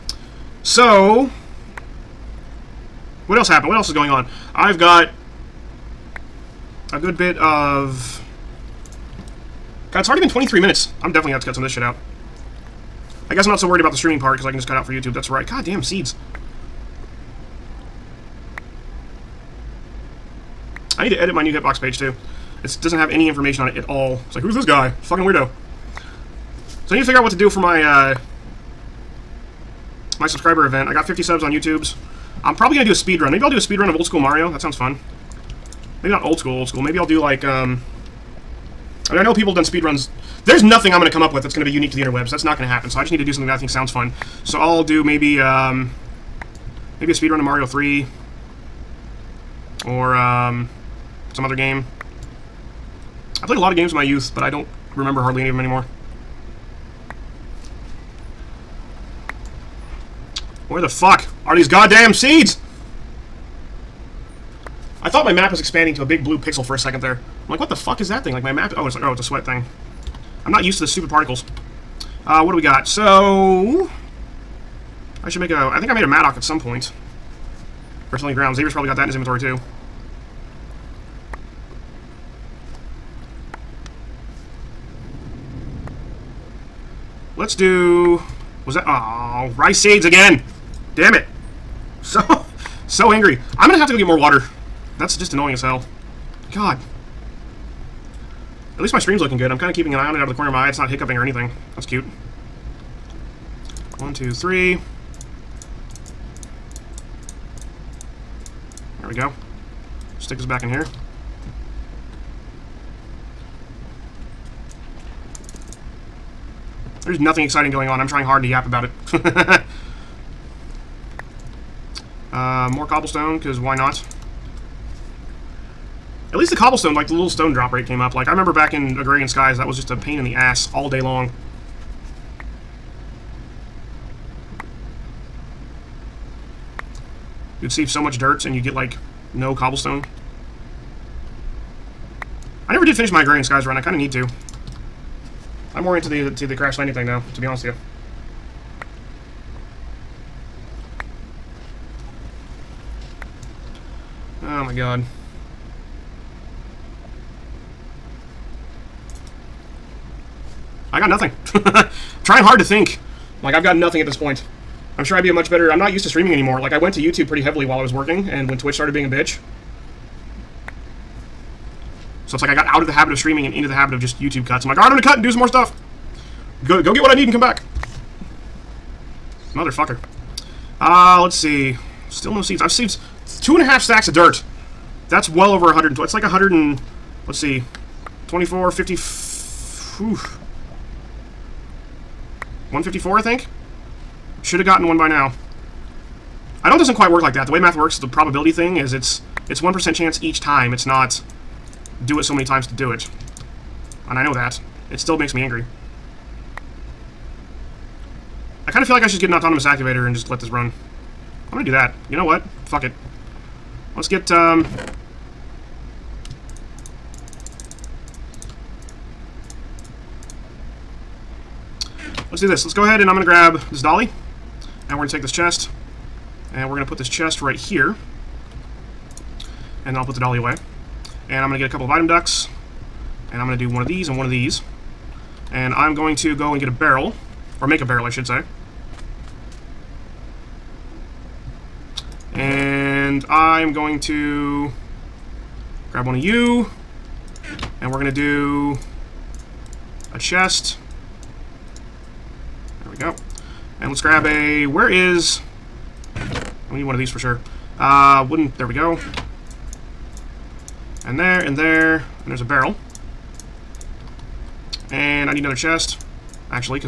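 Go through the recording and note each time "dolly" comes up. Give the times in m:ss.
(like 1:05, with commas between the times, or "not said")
3:43, 3:50.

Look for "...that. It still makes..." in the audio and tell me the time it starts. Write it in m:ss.
3:24.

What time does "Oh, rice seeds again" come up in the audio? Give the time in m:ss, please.
1:28.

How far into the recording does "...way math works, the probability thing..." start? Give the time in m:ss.
3:17.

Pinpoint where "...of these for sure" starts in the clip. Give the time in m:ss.
4:16.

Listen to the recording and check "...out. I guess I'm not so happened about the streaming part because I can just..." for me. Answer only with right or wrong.
wrong.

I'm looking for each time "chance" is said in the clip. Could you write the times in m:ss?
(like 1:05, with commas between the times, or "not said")
3:19.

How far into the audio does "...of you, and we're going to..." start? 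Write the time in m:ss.
4:06.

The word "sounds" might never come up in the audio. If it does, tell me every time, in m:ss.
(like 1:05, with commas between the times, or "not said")
0:34, 0:43.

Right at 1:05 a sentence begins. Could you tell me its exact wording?
I thought my map was expanding to a big blue pixel for a second there.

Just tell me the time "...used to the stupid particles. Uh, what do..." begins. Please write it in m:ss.
1:10.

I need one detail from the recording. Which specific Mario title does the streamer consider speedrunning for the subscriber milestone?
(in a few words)
Mario 3.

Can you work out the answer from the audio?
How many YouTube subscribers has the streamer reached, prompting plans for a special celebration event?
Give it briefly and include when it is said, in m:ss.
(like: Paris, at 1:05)
50, at 0:31.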